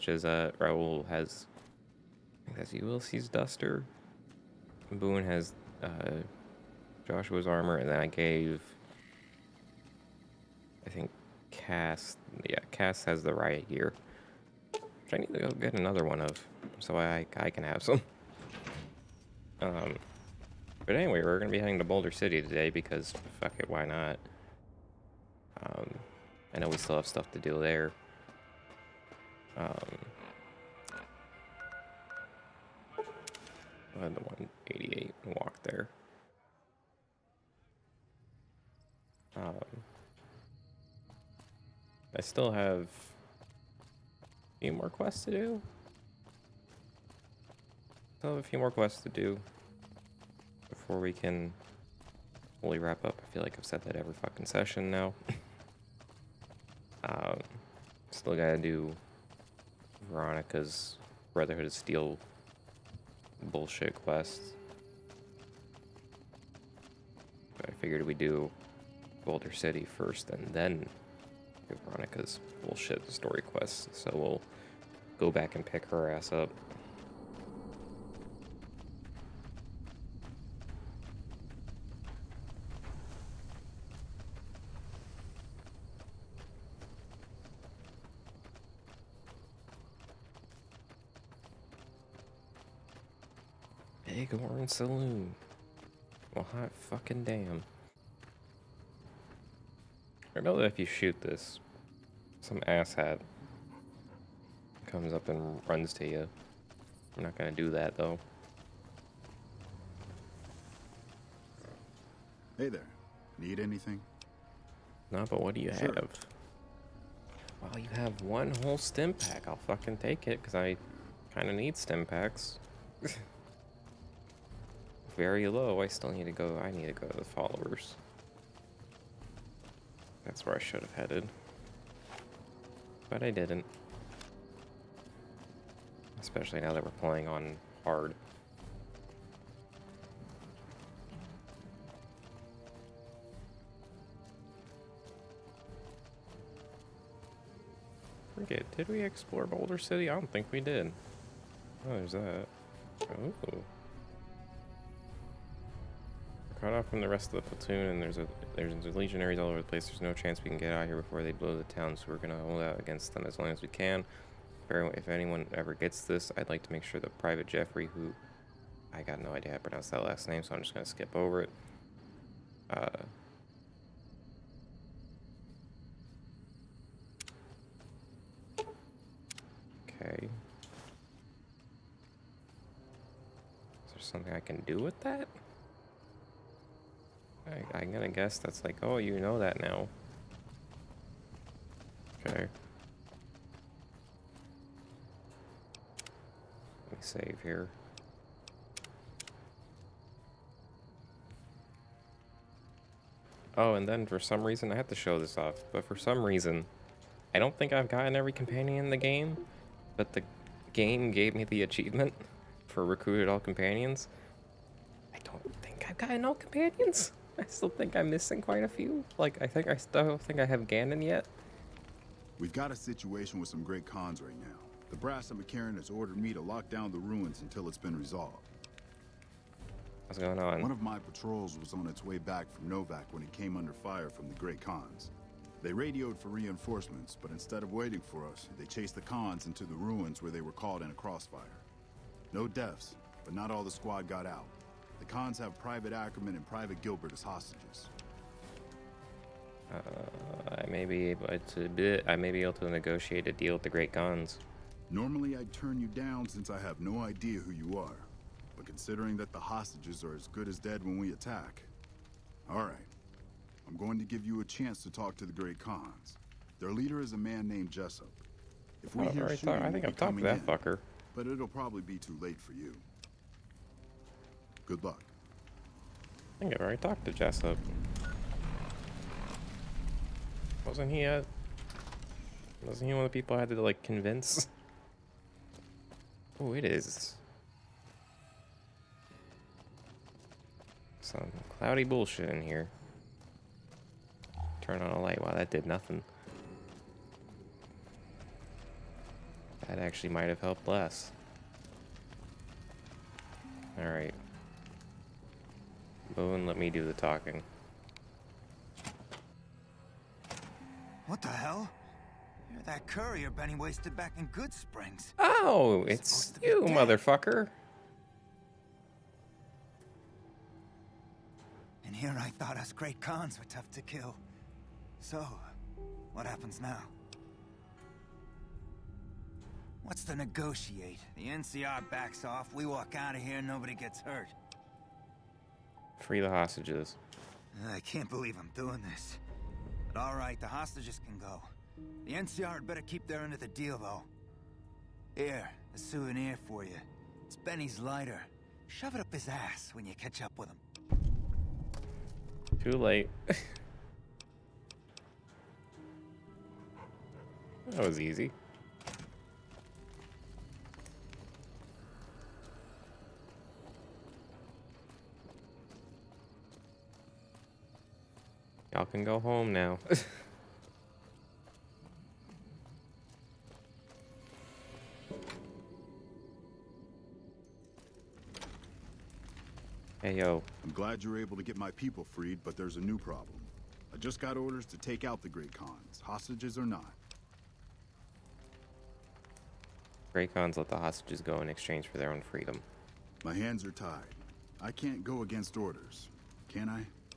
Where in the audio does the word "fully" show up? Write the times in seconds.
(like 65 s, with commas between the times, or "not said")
52 s.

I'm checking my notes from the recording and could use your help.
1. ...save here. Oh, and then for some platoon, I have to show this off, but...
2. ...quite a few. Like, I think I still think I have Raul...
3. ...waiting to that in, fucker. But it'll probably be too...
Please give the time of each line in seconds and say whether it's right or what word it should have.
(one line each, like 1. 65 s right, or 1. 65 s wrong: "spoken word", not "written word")
1. 196 s wrong: "reason", not "platoon"
2. 218 s wrong: "Gannon", not "Raul"
3. 269 s wrong: "talking", not "waiting".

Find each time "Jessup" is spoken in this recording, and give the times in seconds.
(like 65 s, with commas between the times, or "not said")
267 s, 277 s.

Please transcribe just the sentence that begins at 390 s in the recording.
Great Khans let the hostages go in exchange for their own freedom.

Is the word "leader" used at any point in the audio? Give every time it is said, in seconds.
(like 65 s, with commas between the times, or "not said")
266 s.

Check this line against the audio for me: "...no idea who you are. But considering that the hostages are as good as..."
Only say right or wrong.
right.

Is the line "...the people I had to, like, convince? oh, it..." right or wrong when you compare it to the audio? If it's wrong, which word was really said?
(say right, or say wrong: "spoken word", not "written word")
right.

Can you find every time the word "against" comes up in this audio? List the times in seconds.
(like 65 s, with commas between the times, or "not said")
162 s, 395 s.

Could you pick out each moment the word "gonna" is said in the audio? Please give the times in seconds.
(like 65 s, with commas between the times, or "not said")
107 s, 162 s, 170 s, 187 s.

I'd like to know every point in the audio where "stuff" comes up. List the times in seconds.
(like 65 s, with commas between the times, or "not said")
27 s.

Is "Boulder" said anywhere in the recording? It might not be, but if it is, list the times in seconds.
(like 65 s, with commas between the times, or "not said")
21 s, 69 s, 149 s.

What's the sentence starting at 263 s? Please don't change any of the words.
I'm going to give you a chance to talk to the Great Khans.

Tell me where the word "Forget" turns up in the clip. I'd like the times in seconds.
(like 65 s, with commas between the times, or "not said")
148 s.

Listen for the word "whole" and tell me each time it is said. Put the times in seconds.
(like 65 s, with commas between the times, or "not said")
118 s.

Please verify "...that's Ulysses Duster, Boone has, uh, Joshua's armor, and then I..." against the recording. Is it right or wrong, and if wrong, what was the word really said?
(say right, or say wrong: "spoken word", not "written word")
right.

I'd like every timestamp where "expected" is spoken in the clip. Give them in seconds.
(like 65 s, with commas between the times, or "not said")
not said.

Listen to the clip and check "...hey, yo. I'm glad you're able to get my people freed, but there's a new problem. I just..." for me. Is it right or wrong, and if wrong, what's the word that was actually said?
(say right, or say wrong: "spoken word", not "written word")
right.